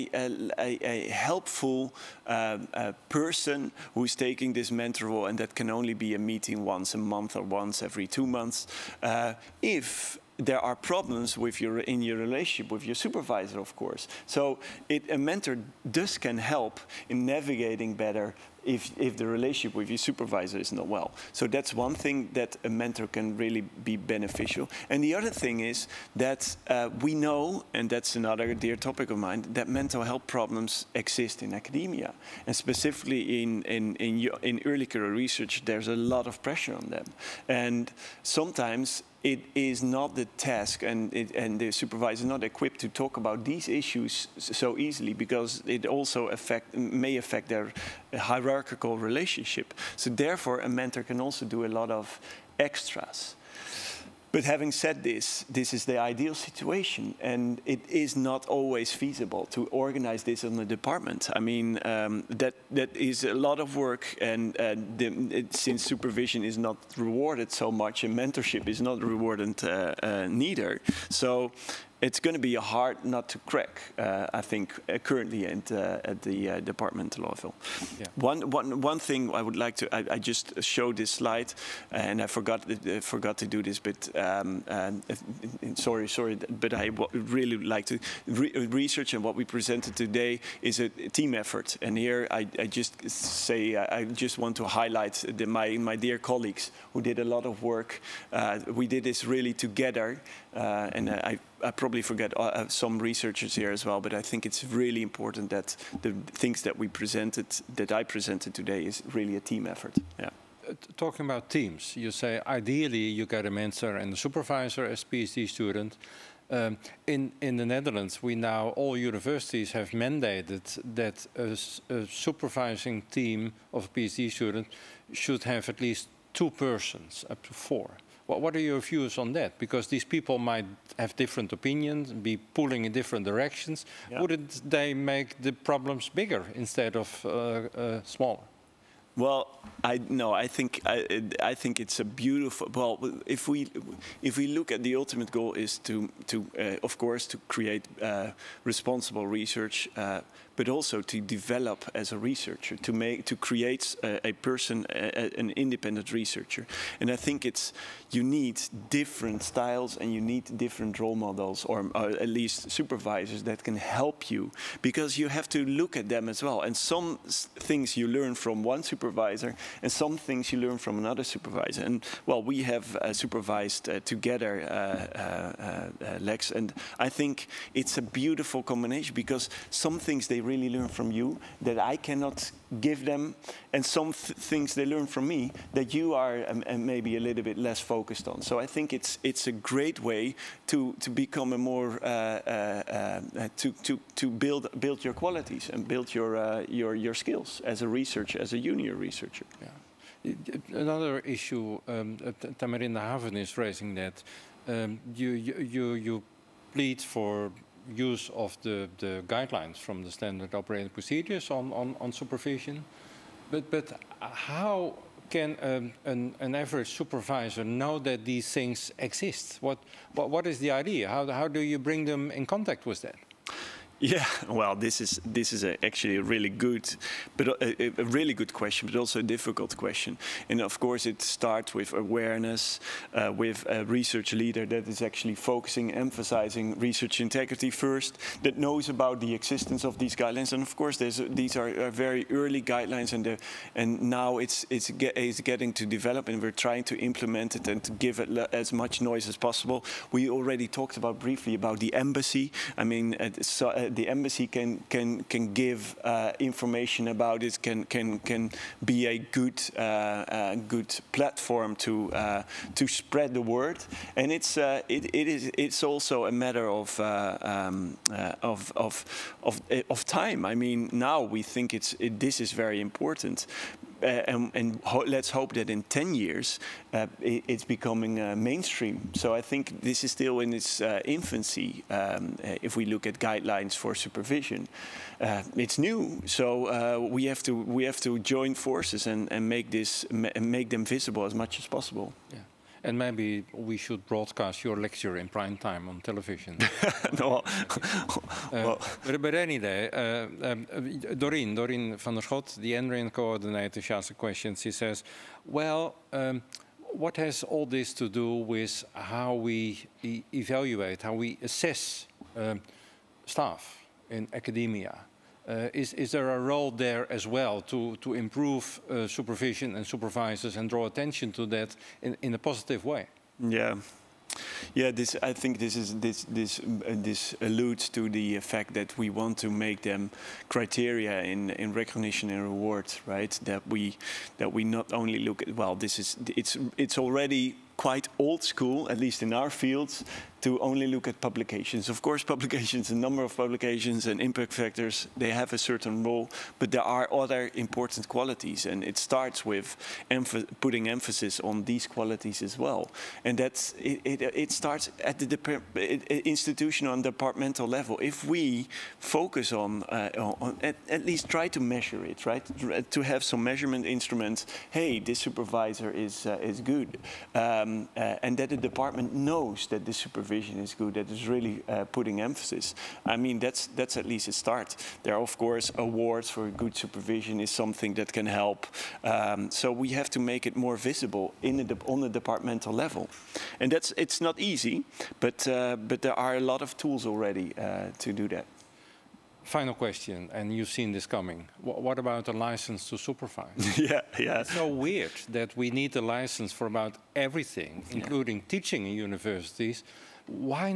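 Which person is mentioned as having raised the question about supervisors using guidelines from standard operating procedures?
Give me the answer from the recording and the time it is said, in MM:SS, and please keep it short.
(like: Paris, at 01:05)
Tamarinde Haven, at 03:22.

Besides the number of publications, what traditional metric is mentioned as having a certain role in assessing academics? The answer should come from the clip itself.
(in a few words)
Impact factors.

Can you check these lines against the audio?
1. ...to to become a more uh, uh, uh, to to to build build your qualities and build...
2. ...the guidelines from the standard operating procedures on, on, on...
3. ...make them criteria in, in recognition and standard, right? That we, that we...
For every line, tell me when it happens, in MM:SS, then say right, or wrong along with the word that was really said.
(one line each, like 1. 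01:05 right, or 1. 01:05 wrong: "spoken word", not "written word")
1. 03:10 right
2. 03:28 right
3. 05:29 wrong: "reward", not "standard".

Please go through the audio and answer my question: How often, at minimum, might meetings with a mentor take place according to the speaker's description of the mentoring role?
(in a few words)
Once a month.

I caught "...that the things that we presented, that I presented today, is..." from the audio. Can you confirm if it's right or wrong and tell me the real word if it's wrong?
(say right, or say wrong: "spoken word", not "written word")
right.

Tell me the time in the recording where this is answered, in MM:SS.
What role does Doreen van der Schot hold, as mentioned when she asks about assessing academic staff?
05:02.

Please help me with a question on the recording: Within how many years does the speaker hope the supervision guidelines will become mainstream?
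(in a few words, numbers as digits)
10.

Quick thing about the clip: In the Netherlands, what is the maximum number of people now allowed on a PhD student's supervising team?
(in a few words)
4.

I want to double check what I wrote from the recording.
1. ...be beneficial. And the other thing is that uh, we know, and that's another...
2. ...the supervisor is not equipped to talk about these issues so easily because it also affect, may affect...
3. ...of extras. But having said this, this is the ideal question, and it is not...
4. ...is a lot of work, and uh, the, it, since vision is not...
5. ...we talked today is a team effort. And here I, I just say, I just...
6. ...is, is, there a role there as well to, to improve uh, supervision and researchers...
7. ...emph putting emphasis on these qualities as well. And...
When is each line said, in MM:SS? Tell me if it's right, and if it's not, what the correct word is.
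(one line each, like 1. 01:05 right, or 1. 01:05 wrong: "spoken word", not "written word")
1. 00:23 right
2. 00:41 right
3. 00:51 wrong: "situation", not "question"
4. 01:02 wrong: "supervision", not "vision"
5. 01:29 wrong: "presented", not "talked"
6. 05:15 wrong: "supervisors", not "researchers"
7. 05:50 right.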